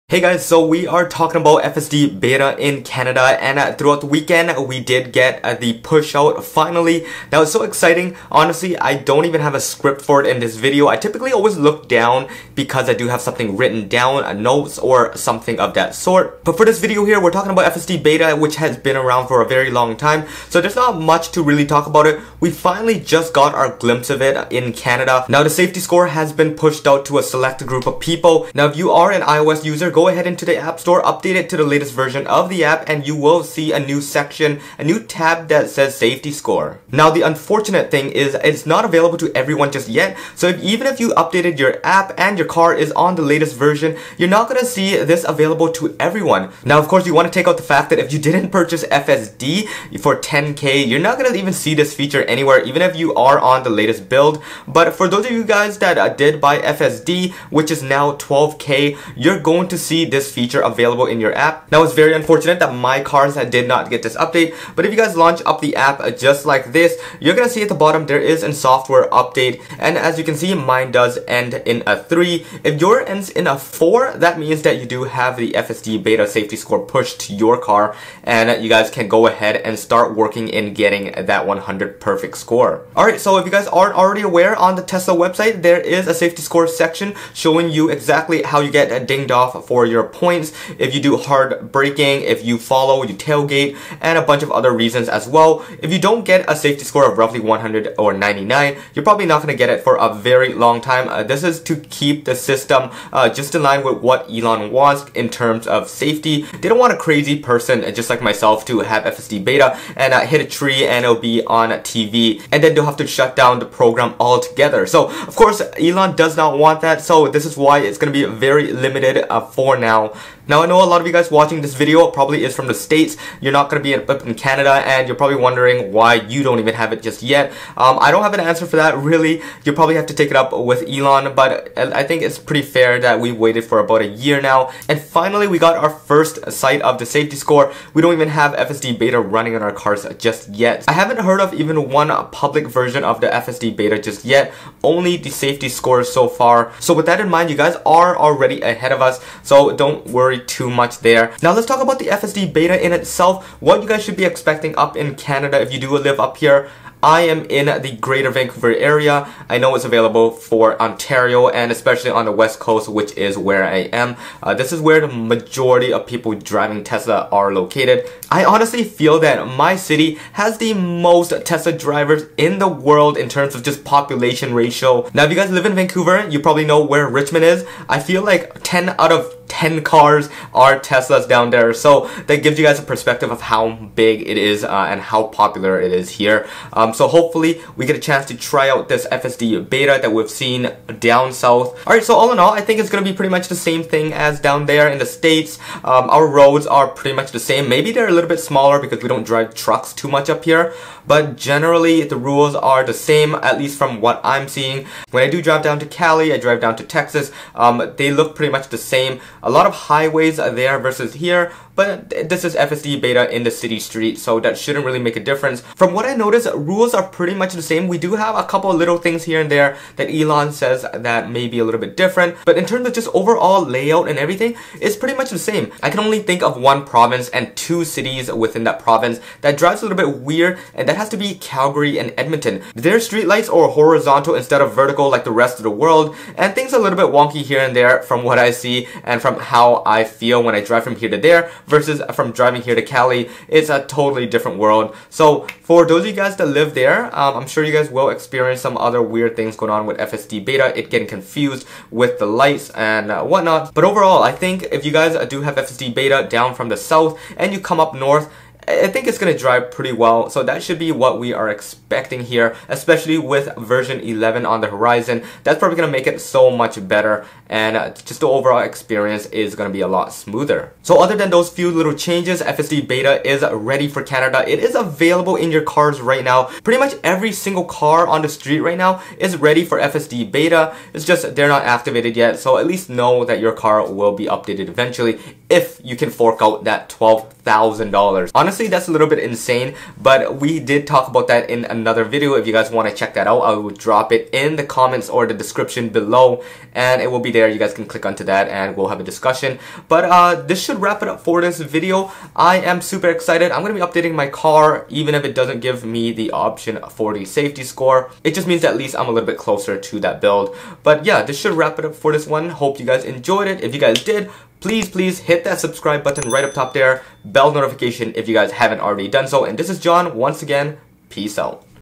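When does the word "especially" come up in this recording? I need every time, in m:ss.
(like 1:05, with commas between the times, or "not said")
2:41, 4:22.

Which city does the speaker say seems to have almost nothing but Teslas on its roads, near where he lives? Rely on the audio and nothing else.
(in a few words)
Richmond.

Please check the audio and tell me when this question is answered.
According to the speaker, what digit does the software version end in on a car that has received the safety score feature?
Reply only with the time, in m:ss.
1:13.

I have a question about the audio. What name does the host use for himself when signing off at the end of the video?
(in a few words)
John.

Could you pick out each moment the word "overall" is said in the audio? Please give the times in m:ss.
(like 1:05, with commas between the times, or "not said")
3:43, 4:13, 4:28.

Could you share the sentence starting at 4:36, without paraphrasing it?
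Pretty much every single car on the street right now is ready for FSD Beta.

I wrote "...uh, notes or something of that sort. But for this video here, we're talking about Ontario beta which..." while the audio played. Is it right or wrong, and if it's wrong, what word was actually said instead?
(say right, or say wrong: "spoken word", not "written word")
wrong: "FSD", not "Ontario".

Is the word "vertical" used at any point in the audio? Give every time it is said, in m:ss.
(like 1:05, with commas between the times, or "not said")
3:54.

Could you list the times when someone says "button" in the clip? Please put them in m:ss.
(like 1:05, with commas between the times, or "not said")
5:16.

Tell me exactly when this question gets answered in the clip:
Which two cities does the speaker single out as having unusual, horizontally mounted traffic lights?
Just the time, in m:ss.
3:51.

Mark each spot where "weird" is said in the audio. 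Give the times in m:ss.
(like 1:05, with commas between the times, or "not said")
3:50, 4:09.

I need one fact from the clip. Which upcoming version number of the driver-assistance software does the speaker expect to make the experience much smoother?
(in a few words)
11.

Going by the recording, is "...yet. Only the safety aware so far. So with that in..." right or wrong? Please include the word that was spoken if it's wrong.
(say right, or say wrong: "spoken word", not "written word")
wrong: "score", not "aware".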